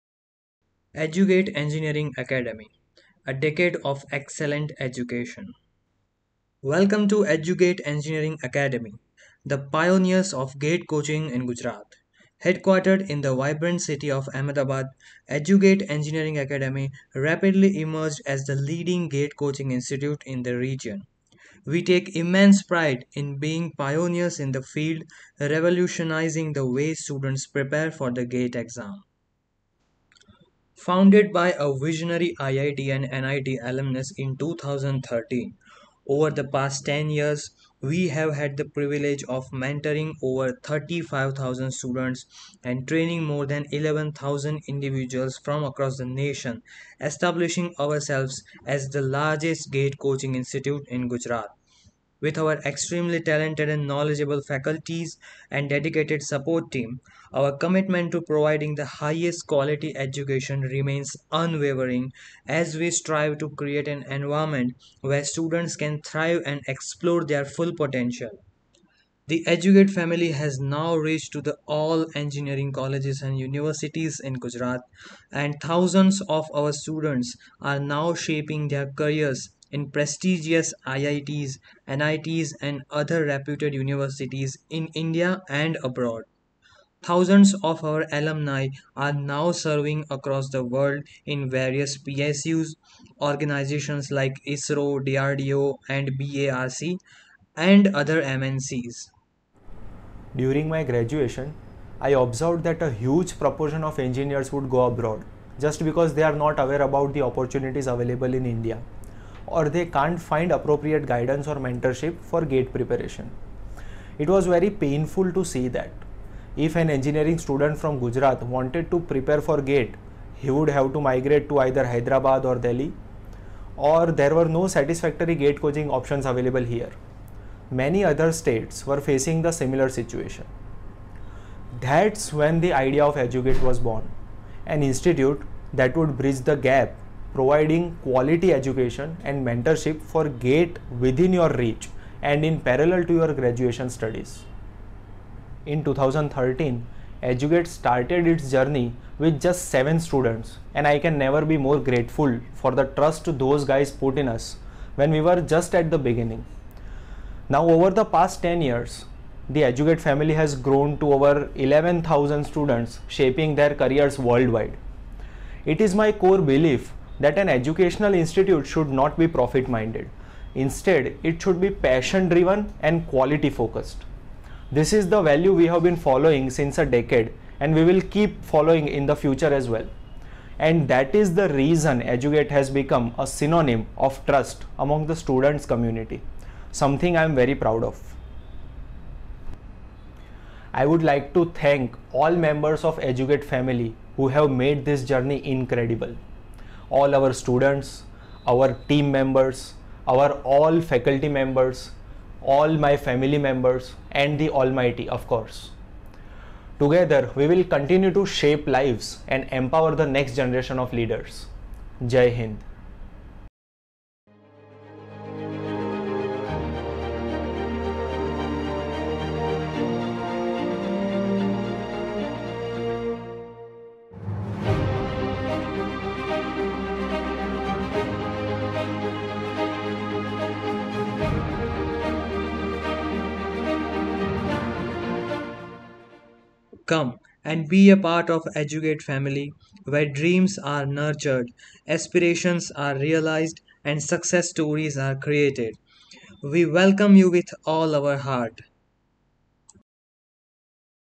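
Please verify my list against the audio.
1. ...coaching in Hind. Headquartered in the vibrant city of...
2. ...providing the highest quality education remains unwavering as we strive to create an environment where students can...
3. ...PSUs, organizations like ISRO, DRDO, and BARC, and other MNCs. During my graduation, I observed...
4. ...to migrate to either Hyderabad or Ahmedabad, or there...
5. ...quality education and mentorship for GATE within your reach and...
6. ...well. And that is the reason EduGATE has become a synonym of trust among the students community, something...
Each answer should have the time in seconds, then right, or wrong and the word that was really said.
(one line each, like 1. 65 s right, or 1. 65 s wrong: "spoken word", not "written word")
1. 10 s wrong: "Gujarat", not "Hind"
2. 58 s right
3. 91 s right
4. 120 s wrong: "Delhi", not "Ahmedabad"
5. 138 s right
6. 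179 s right.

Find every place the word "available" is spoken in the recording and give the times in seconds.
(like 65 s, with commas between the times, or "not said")
107 s, 126 s.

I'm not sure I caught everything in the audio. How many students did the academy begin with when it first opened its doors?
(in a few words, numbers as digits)
7.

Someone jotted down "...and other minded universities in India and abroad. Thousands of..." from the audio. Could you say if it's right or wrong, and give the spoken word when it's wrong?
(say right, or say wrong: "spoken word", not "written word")
wrong: "reputed", not "minded".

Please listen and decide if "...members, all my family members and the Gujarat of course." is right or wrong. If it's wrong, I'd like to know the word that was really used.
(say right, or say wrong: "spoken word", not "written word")
wrong: "Almighty", not "Gujarat".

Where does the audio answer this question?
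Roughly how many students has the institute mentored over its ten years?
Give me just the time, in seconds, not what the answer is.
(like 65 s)
40 s.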